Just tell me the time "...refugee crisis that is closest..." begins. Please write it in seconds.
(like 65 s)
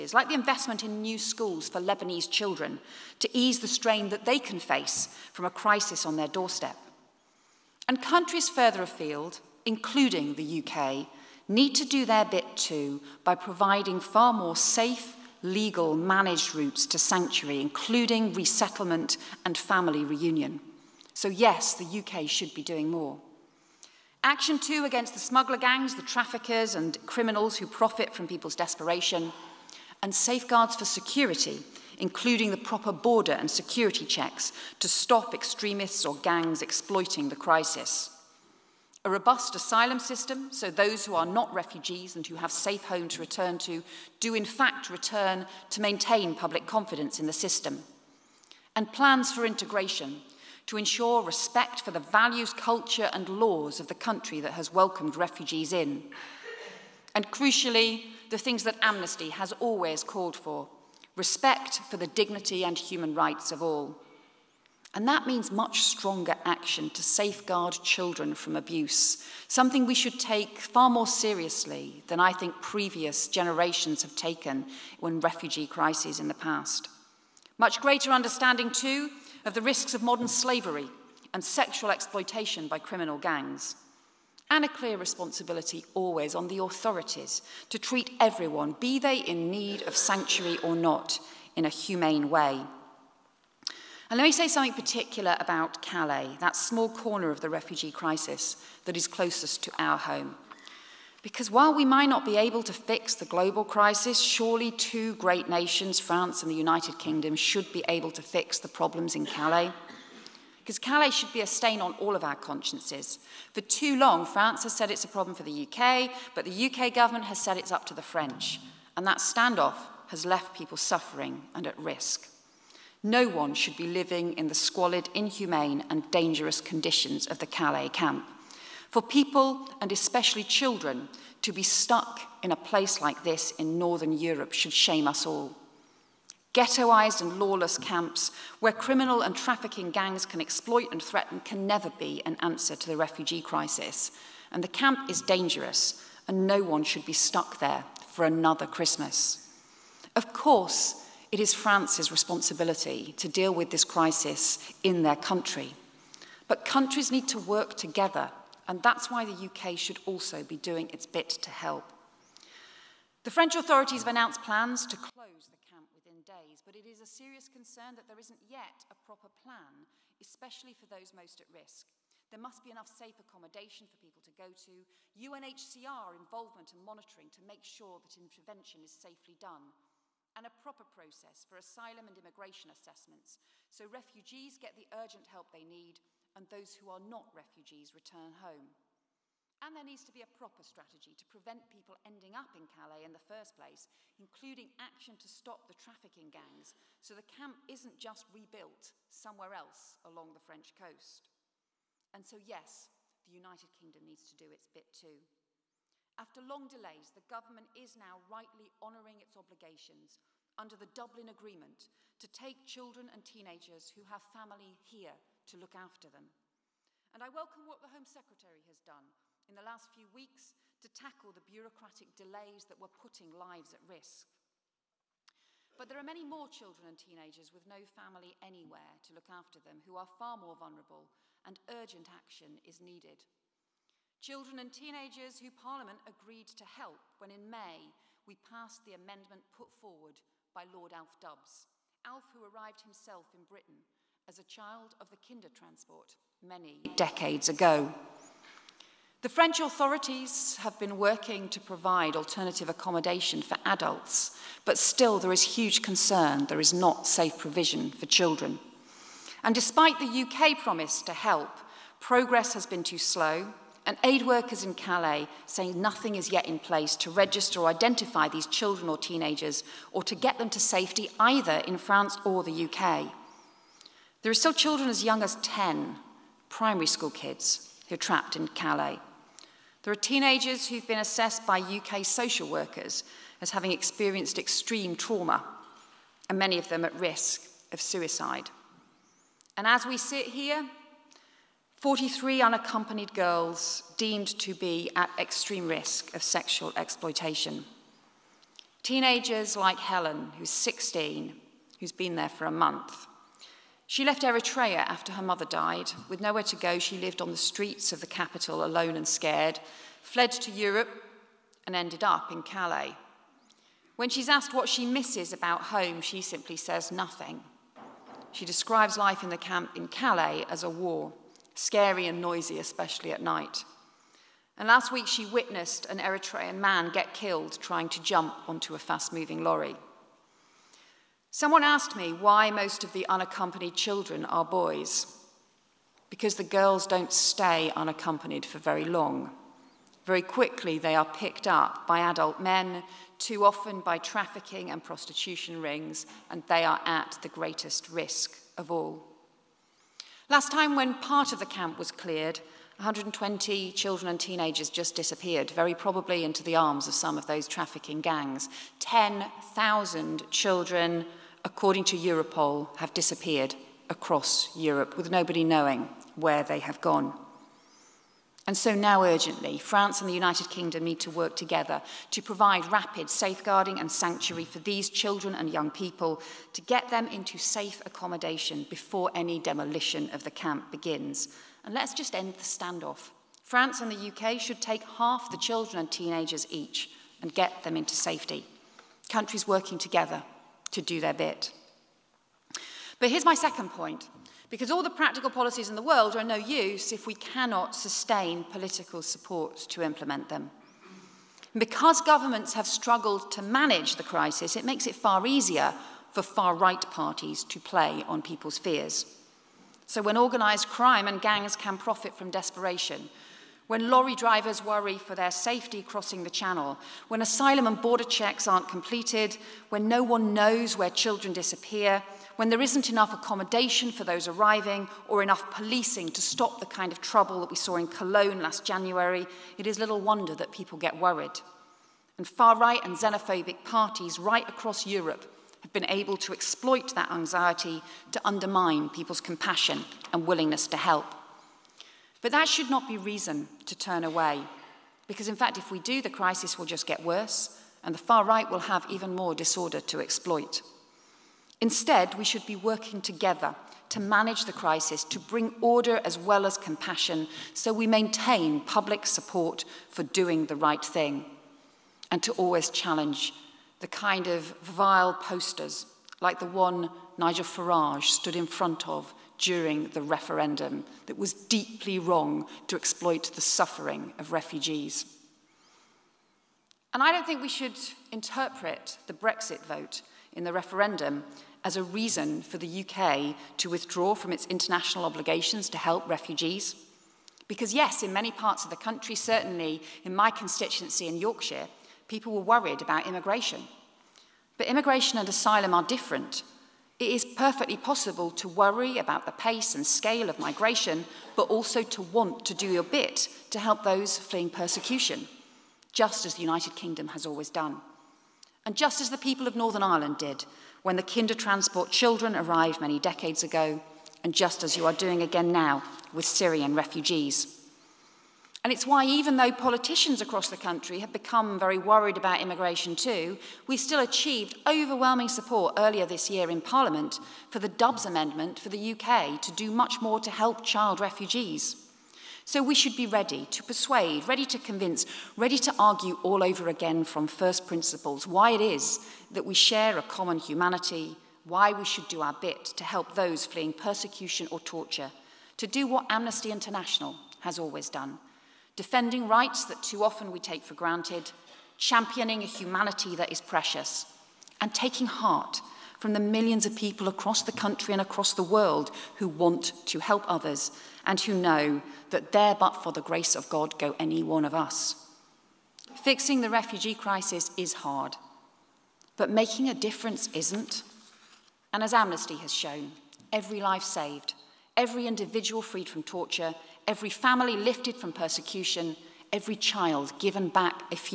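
97 s.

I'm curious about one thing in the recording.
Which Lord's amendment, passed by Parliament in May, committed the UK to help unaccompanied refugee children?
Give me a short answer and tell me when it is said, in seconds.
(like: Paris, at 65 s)
Alf Dubs, at 240 s.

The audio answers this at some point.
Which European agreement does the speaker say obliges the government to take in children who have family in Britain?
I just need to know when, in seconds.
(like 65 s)
210 s.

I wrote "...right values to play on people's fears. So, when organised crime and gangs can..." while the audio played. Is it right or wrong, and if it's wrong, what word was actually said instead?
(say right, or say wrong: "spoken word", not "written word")
wrong: "parties", not "values".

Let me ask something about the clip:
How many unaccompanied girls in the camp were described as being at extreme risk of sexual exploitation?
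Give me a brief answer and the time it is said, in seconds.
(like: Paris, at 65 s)
43, at 291 s.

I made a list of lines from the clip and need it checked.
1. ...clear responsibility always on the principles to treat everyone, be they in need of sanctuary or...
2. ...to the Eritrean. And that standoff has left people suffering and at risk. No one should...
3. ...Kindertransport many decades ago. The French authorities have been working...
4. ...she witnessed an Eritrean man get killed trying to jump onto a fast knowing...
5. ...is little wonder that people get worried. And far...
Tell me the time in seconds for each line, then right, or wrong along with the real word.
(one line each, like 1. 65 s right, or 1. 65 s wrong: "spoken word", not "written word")
1. 84 s wrong: "authorities", not "principles"
2. 117 s wrong: "French", not "Eritrean"
3. 245 s right
4. 325 s wrong: "moving", not "knowing"
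5. 429 s right.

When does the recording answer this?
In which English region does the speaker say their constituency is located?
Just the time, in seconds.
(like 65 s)
491 s.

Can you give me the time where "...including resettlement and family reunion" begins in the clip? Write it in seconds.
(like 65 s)
17 s.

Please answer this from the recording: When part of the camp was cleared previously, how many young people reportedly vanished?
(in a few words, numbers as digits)
120.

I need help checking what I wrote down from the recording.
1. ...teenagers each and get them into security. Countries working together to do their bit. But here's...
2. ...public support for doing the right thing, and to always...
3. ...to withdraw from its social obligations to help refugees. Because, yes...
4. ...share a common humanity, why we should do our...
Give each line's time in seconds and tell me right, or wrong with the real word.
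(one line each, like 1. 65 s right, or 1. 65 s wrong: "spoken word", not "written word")
1. 385 s wrong: "safety", not "security"
2. 458 s right
3. 483 s wrong: "international", not "social"
4. 539 s right.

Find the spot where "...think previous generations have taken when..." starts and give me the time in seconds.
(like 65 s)
72 s.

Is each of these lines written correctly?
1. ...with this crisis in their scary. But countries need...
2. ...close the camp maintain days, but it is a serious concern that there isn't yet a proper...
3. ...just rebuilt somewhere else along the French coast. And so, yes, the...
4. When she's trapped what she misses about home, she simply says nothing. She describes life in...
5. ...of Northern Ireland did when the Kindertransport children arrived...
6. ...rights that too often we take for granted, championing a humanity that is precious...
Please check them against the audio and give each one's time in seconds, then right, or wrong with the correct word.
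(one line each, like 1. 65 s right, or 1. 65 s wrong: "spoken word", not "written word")
1. 153 s wrong: "country", not "scary"
2. 164 s wrong: "within", not "maintain"
3. 197 s right
4. 313 s wrong: "asked", not "trapped"
5. 509 s right
6. 549 s right.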